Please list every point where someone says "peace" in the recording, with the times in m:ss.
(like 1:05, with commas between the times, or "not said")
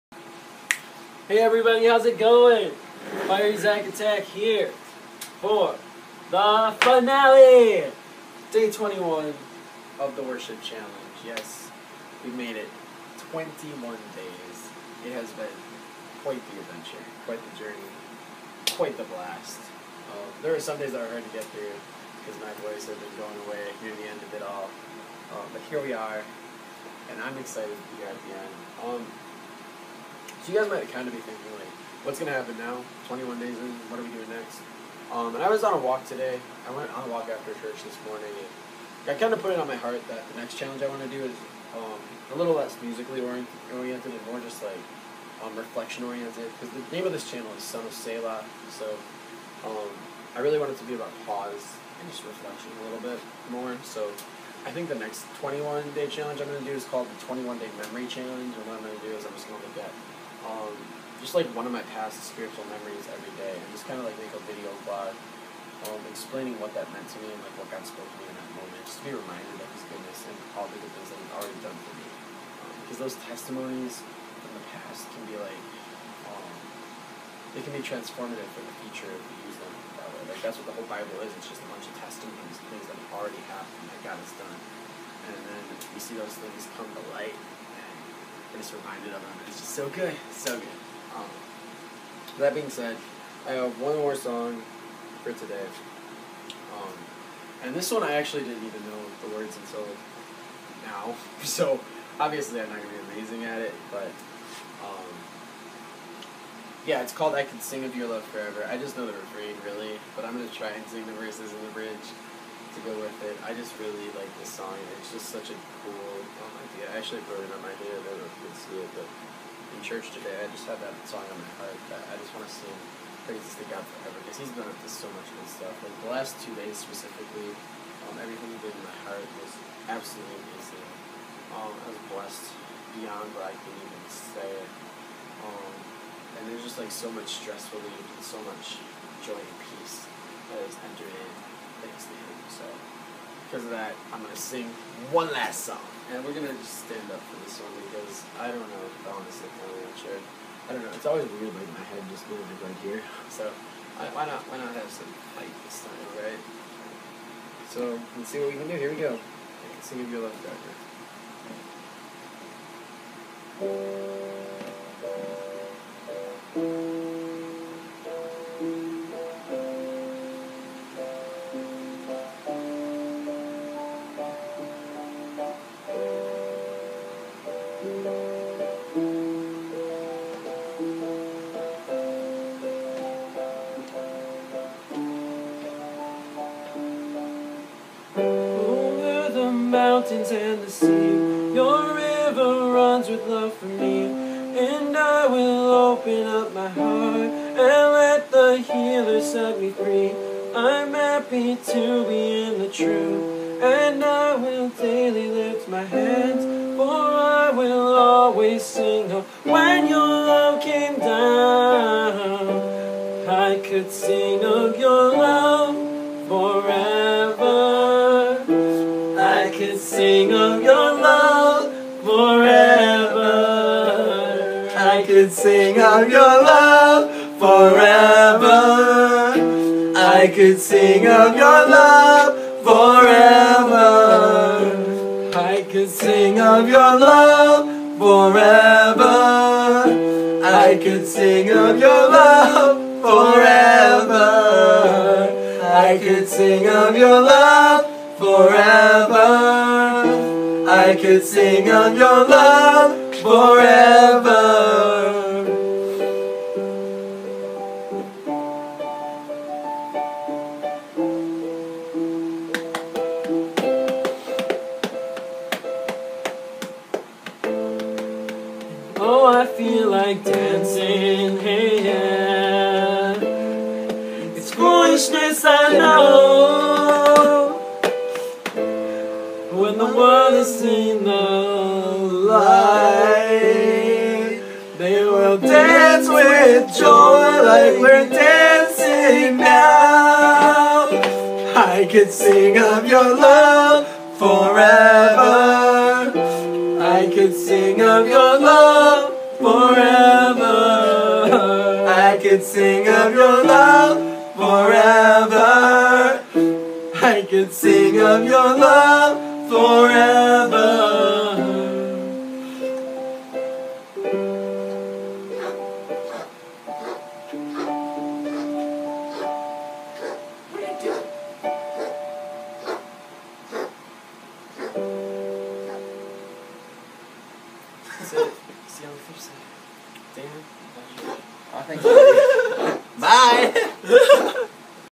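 2:19.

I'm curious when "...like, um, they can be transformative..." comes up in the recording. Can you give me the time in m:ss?
1:15.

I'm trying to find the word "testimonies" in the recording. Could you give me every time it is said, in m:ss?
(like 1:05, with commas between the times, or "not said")
1:13, 1:22.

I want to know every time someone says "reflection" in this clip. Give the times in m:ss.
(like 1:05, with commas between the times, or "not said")
0:45, 0:52.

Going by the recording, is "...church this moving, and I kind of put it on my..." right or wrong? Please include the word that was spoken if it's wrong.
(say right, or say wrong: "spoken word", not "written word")
wrong: "morning", not "moving".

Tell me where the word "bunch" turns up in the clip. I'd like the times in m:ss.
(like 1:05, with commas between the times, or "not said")
1:21.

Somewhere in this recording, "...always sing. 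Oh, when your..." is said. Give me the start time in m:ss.
3:27.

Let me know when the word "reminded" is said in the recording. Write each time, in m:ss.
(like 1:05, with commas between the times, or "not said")
1:09, 1:28.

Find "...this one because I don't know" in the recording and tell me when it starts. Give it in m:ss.
2:27.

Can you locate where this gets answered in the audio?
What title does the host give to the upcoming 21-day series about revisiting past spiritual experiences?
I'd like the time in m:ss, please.
0:57.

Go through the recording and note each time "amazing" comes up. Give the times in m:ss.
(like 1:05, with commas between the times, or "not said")
1:43, 2:10.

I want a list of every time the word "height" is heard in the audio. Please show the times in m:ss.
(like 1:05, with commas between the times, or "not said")
2:35.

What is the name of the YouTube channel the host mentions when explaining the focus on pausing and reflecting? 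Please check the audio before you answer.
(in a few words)
Son of Selah.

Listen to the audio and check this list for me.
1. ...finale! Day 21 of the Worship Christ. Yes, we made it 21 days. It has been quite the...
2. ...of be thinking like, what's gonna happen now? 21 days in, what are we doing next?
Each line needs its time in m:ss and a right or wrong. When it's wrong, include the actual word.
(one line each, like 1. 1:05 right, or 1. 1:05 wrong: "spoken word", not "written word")
1. 0:06 wrong: "Challenge", not "Christ"
2. 0:31 right.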